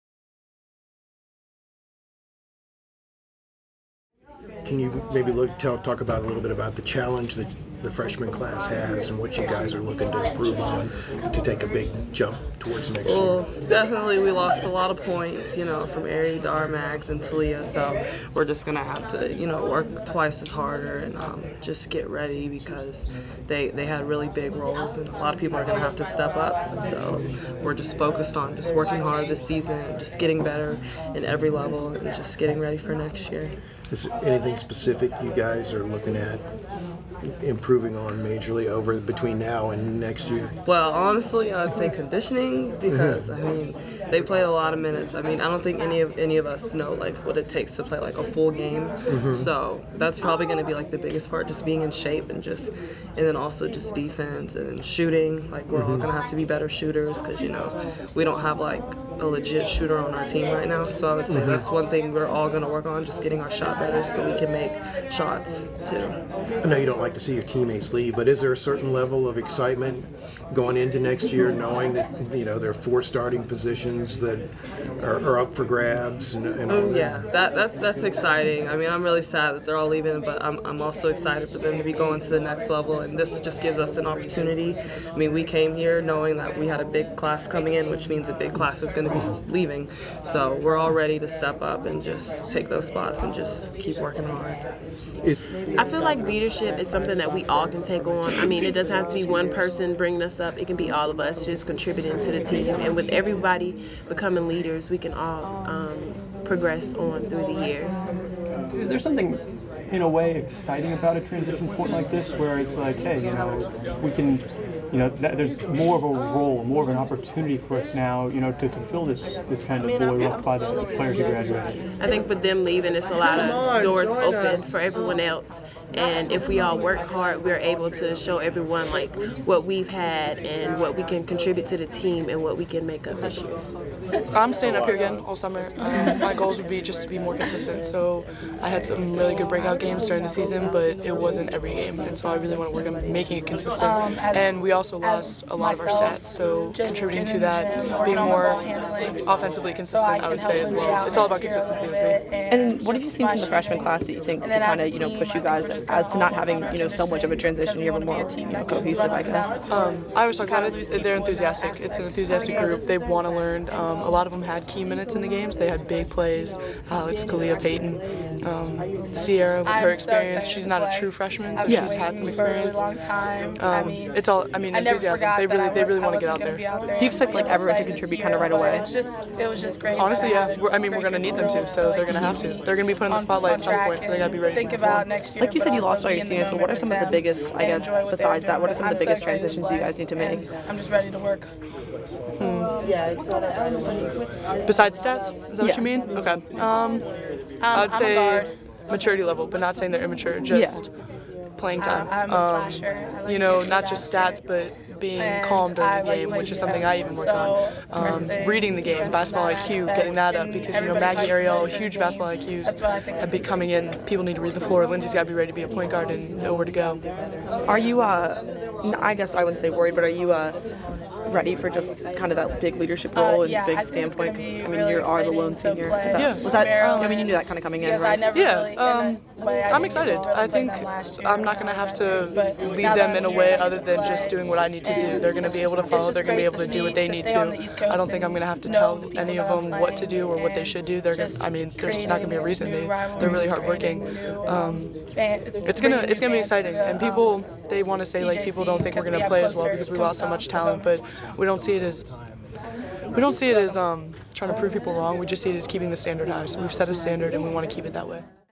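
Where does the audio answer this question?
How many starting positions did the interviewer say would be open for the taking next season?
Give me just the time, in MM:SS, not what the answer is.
01:12.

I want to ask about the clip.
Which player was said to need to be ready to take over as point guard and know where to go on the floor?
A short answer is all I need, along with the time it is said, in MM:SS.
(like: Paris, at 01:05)
Lindsey, at 03:34.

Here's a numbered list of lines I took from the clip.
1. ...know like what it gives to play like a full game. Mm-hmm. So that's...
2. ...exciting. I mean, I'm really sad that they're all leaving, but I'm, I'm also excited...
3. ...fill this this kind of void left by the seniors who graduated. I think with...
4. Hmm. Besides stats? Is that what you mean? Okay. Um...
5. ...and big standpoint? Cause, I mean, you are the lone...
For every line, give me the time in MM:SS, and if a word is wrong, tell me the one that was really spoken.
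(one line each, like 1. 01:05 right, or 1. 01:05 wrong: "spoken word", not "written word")
1. 00:46 wrong: "takes", not "gives"
2. 01:18 right
3. 01:58 wrong: "players", not "seniors"
4. 03:11 right
5. 03:43 right.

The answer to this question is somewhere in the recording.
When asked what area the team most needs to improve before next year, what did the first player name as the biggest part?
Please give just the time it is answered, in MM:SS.
00:41.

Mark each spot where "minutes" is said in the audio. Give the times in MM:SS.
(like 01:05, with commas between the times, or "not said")
00:44, 02:44.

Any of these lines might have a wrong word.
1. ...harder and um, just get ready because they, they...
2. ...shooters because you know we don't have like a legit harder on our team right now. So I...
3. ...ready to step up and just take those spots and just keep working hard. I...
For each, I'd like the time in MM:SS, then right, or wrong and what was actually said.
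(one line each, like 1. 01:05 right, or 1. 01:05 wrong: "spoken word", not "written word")
1. 00:20 right
2. 00:56 wrong: "shooter", not "harder"
3. 01:30 right.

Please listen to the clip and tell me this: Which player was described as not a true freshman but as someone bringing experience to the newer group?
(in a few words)
Sierra.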